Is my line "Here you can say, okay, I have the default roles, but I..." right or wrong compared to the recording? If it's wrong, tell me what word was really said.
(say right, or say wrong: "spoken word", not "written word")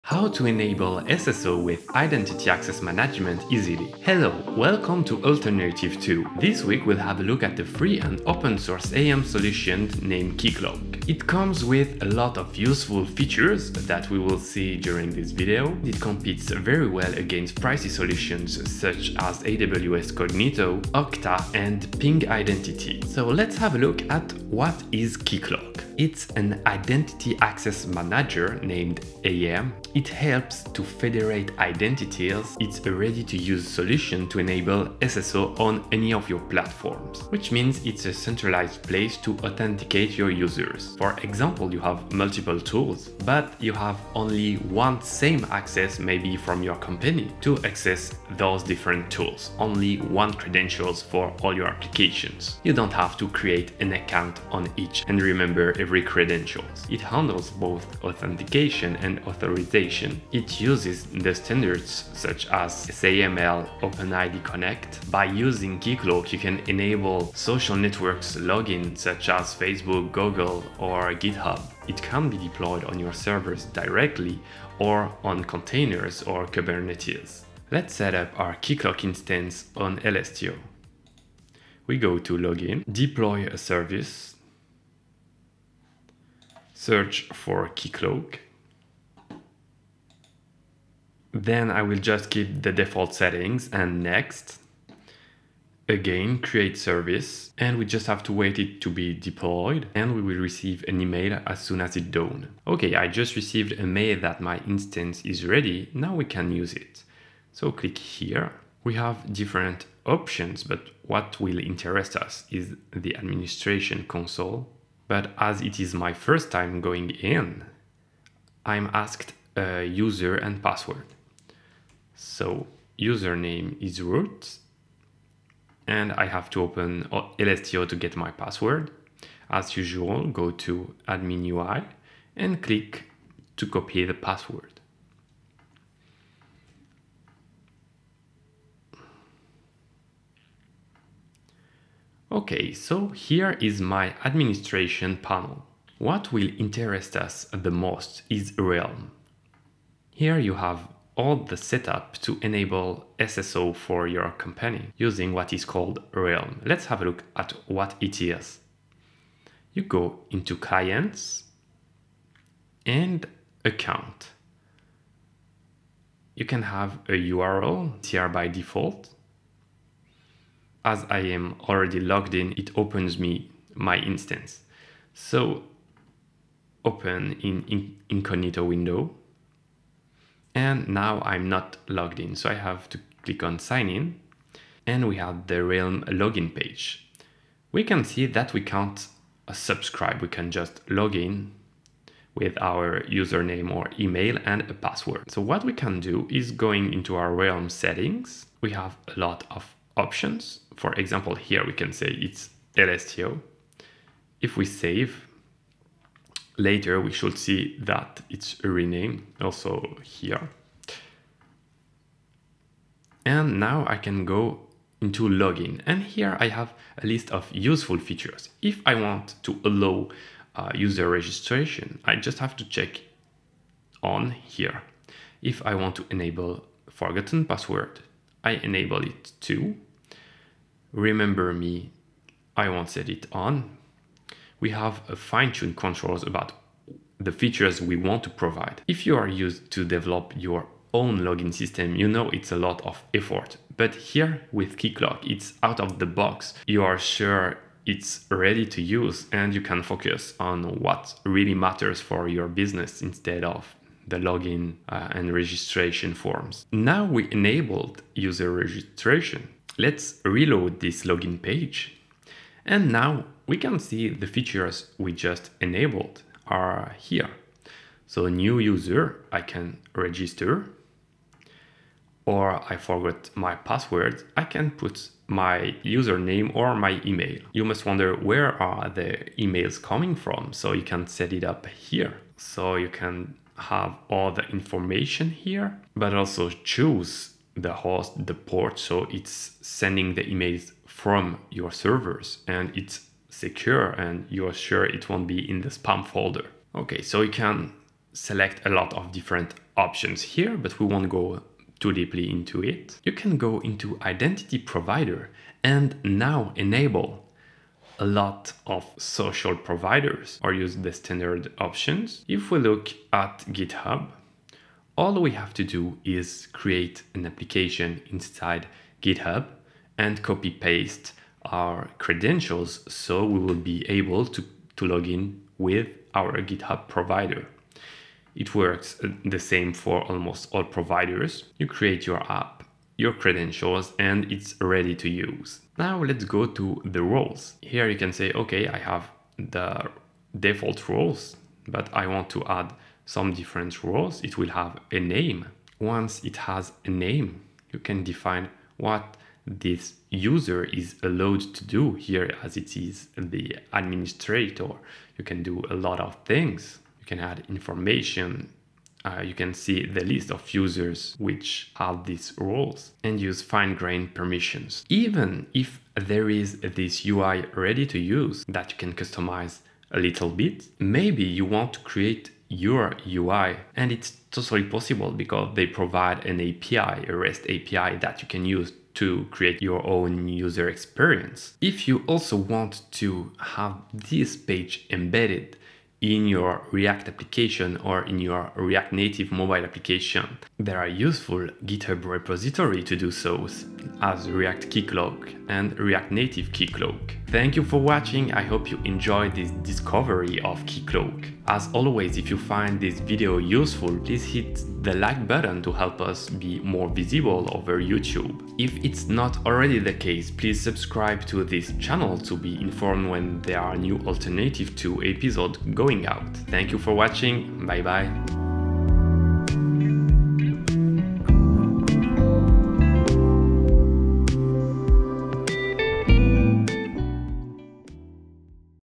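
right.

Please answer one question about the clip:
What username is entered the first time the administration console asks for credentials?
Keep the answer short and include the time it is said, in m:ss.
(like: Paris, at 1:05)
root, at 2:04.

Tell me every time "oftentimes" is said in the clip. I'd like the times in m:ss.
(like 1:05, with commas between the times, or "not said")
not said.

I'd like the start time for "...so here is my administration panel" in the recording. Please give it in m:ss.
2:22.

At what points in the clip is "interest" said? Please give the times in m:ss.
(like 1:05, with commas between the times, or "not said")
1:51, 2:26.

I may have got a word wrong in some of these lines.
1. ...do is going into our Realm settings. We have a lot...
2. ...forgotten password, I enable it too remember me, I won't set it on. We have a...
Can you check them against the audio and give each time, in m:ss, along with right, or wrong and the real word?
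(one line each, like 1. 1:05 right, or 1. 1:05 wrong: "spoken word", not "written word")
1. 3:15 right
2. 3:46 right.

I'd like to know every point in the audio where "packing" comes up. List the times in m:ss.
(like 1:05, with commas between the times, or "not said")
not said.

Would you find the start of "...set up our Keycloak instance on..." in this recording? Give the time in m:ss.
1:17.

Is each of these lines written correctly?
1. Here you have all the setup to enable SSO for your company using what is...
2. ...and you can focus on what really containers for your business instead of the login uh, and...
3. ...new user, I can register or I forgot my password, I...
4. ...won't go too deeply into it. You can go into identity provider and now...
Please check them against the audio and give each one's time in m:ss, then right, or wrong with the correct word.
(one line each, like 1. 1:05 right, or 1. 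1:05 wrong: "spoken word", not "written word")
1. 2:30 right
2. 4:09 wrong: "matters", not "containers"
3. 4:28 right
4. 5:00 right.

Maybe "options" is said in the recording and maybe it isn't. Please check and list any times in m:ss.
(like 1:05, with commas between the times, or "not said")
1:50, 3:19, 4:59, 5:11.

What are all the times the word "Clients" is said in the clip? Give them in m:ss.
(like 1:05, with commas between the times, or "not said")
2:40.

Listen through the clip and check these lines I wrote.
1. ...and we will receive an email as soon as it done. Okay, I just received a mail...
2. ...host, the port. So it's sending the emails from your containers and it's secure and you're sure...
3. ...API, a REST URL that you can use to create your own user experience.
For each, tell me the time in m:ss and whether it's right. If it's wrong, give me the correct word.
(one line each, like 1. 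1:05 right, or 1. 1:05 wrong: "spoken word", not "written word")
1. 1:39 right
2. 4:47 wrong: "servers", not "containers"
3. 6:16 wrong: "API", not "URL".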